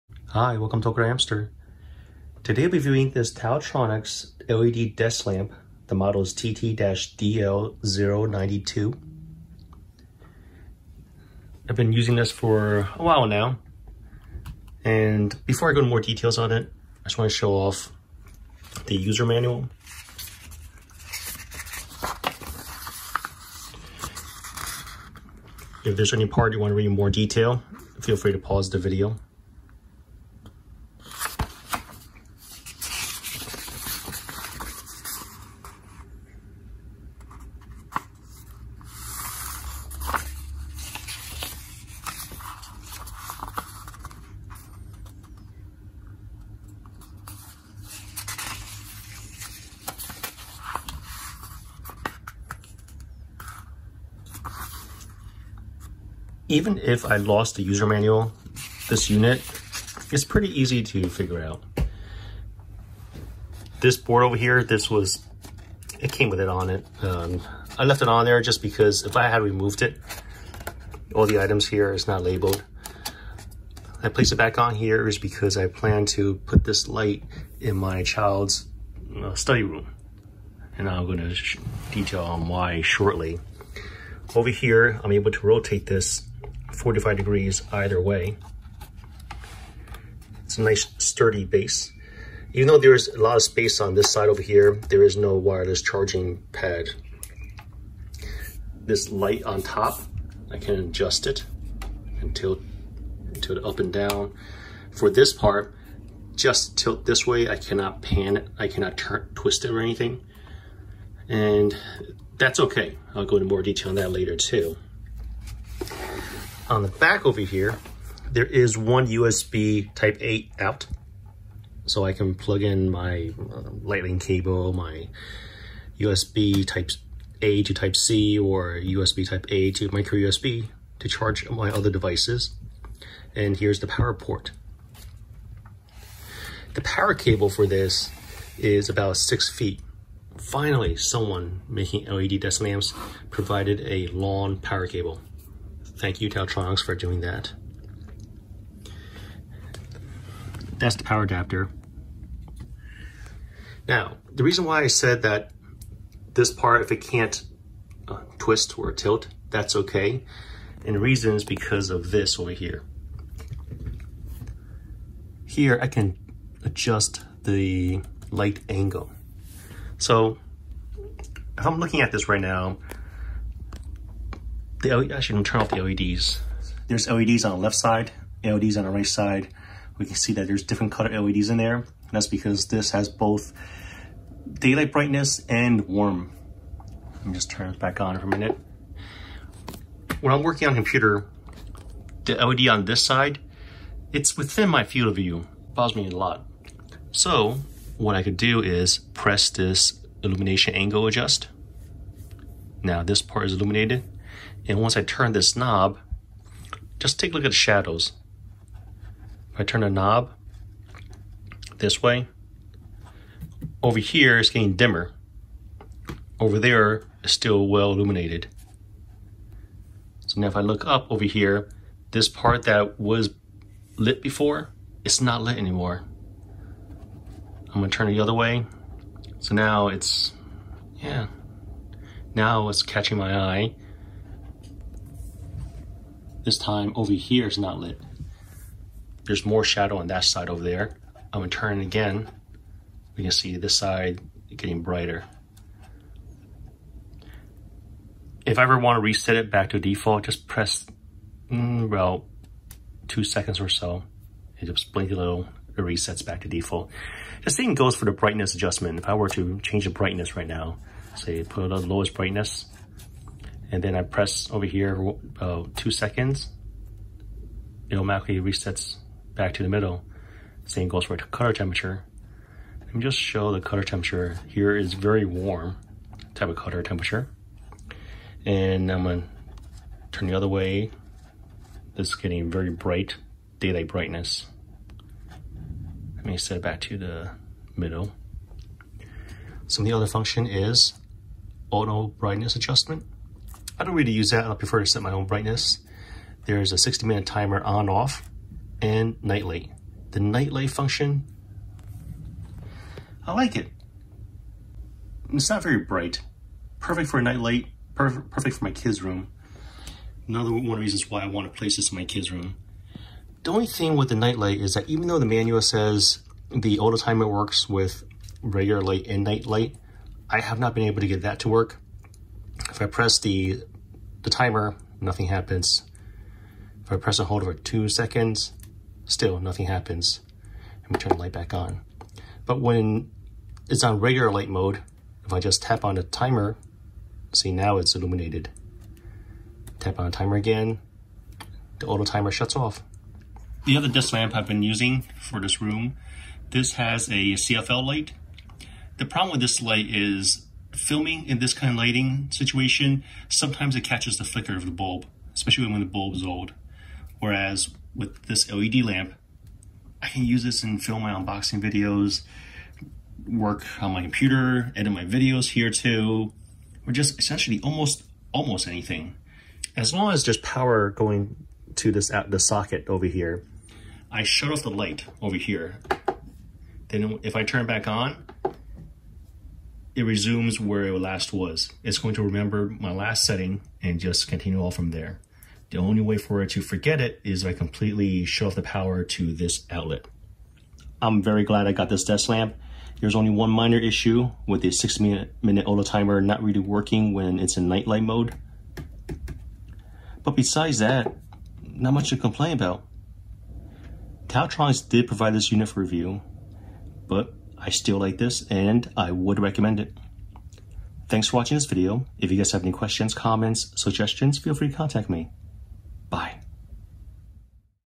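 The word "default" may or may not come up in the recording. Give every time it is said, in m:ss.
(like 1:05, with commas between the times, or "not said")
4:09, 4:16.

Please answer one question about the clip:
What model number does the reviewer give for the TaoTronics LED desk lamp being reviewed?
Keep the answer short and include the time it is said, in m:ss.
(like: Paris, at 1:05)
TT-DL092, at 0:06.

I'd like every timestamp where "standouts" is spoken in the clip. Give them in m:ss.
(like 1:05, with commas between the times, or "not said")
not said.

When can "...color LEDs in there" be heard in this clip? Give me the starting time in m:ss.
3:00.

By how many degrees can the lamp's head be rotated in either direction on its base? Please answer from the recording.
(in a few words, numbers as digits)
45 degrees.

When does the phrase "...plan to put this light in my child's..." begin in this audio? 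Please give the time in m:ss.
1:15.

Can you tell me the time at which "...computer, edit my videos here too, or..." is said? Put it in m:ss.
6:04.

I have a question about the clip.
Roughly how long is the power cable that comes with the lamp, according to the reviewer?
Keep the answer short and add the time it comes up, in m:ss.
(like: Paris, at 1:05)
6 feet, at 2:18.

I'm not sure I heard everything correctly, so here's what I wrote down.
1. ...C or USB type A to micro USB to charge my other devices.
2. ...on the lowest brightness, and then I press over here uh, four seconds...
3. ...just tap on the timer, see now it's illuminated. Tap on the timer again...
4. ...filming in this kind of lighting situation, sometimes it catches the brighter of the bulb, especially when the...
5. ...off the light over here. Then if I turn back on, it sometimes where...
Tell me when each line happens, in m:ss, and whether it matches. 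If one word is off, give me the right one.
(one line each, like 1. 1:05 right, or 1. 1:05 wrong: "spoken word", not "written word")
1. 2:07 right
2. 4:21 wrong: "two", not "four"
3. 5:35 right
4. 5:50 wrong: "flicker", not "brighter"
5. 6:14 wrong: "resumes", not "sometimes".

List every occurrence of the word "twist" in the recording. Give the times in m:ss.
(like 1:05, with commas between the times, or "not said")
1:49, 2:38.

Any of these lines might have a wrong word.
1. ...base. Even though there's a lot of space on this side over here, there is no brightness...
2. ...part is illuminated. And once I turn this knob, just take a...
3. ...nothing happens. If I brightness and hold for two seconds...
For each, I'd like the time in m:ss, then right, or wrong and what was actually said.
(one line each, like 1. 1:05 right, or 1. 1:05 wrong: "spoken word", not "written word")
1. 1:31 wrong: "wireless", not "brightness"
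2. 3:23 right
3. 5:24 wrong: "press", not "brightness".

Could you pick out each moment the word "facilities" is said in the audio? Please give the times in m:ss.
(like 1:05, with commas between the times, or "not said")
not said.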